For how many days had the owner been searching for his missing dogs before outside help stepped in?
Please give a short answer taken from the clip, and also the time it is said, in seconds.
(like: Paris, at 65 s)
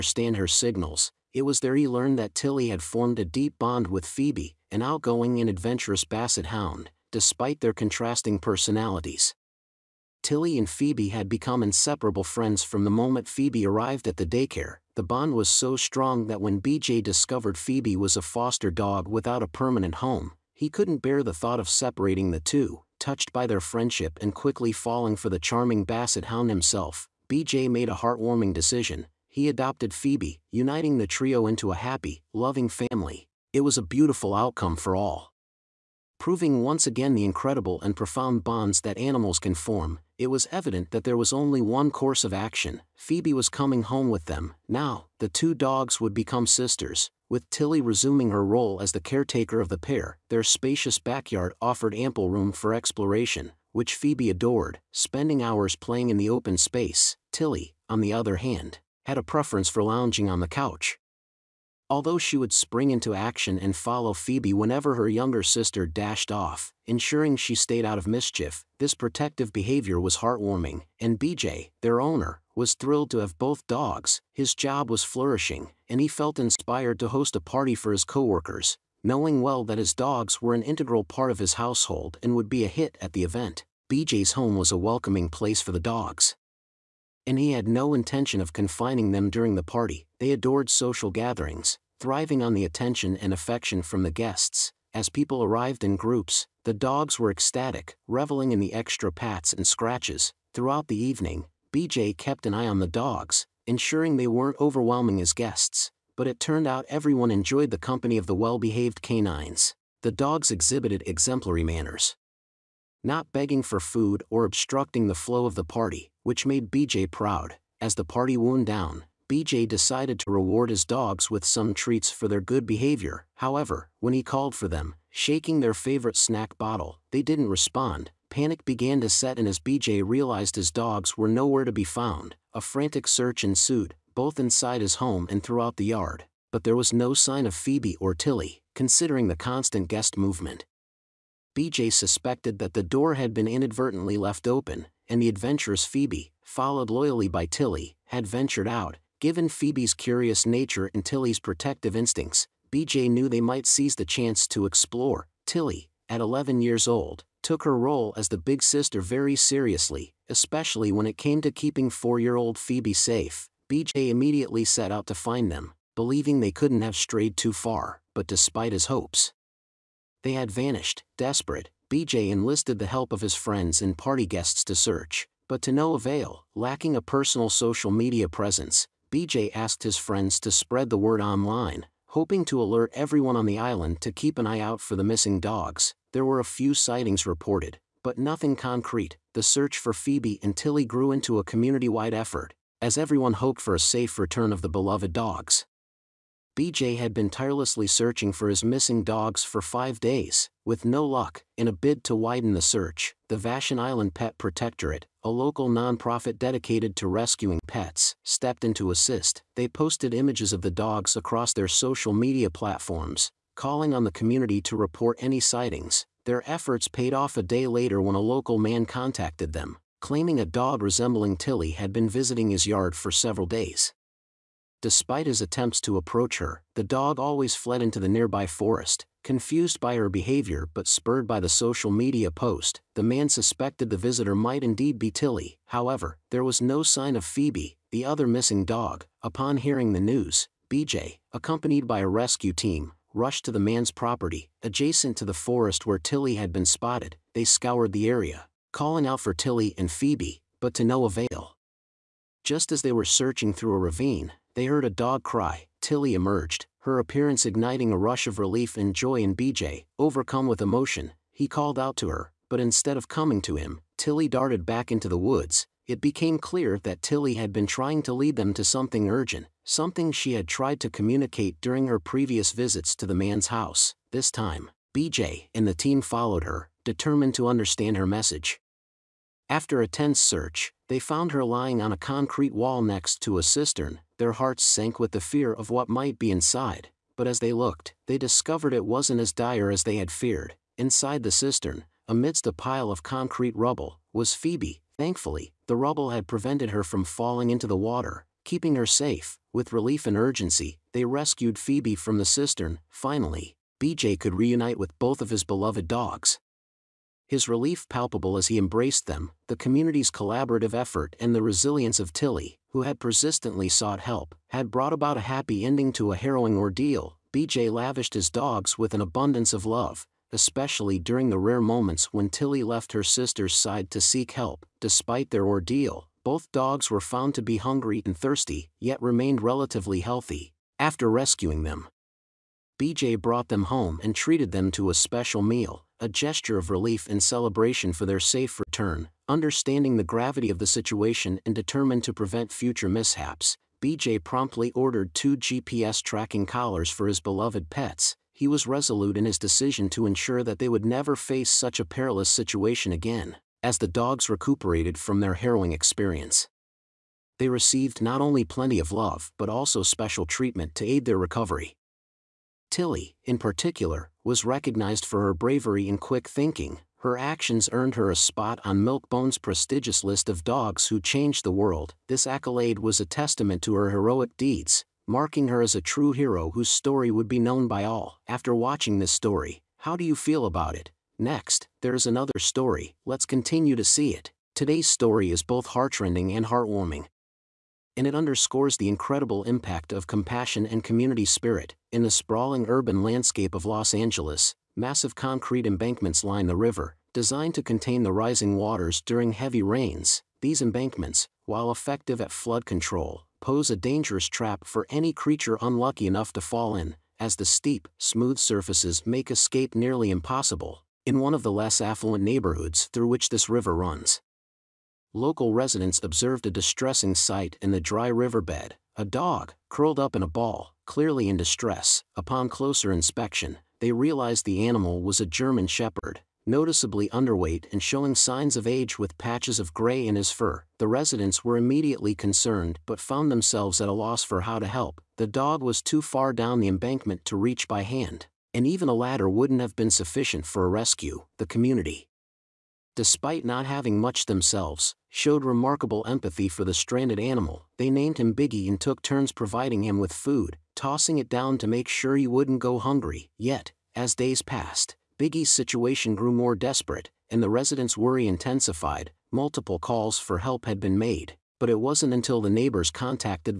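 5, at 199 s.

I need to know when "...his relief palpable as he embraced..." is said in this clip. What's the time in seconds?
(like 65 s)
307 s.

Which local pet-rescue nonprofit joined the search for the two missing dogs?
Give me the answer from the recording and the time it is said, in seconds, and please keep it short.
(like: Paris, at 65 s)
Vashon Island Pet Protectorate, at 203 s.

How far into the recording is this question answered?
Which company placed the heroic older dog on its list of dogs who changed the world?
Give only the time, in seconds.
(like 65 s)
368 s.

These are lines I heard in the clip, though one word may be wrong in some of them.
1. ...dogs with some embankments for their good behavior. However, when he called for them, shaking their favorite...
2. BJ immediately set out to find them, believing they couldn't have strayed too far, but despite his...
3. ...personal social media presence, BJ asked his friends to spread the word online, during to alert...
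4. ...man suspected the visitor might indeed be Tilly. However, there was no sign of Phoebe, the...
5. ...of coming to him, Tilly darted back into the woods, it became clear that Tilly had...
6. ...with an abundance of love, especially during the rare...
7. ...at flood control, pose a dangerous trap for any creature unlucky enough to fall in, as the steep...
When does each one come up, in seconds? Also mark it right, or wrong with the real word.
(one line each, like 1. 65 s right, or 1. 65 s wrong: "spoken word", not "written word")
1. 120 s wrong: "treats", not "embankments"
2. 163 s right
3. 177 s wrong: "hoping", not "during"
4. 233 s right
5. 262 s right
6. 318 s right
7. 402 s right.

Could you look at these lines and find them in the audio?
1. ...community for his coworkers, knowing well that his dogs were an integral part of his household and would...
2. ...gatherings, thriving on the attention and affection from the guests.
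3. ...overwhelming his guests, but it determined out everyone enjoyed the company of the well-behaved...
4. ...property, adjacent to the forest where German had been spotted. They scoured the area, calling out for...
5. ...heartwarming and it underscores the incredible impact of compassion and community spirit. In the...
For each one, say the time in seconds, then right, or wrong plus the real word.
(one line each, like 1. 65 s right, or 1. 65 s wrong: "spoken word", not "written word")
1. 77 s wrong: "party", not "community"
2. 91 s right
3. 104 s wrong: "turned", not "determined"
4. 243 s wrong: "Tilly", not "German"
5. 386 s right.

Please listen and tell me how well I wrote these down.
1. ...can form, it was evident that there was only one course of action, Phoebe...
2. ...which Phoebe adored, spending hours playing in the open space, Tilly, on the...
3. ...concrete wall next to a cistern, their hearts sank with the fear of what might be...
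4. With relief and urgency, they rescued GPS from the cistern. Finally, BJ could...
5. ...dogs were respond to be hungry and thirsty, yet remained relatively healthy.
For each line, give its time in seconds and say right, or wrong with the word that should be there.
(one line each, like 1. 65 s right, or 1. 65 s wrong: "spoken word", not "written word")
1. 39 s right
2. 53 s right
3. 281 s right
4. 299 s wrong: "Phoebe", not "GPS"
5. 326 s wrong: "found", not "respond".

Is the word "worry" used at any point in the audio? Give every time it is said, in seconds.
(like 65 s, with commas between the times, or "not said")
457 s.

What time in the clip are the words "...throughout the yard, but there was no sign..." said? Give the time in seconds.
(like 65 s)
135 s.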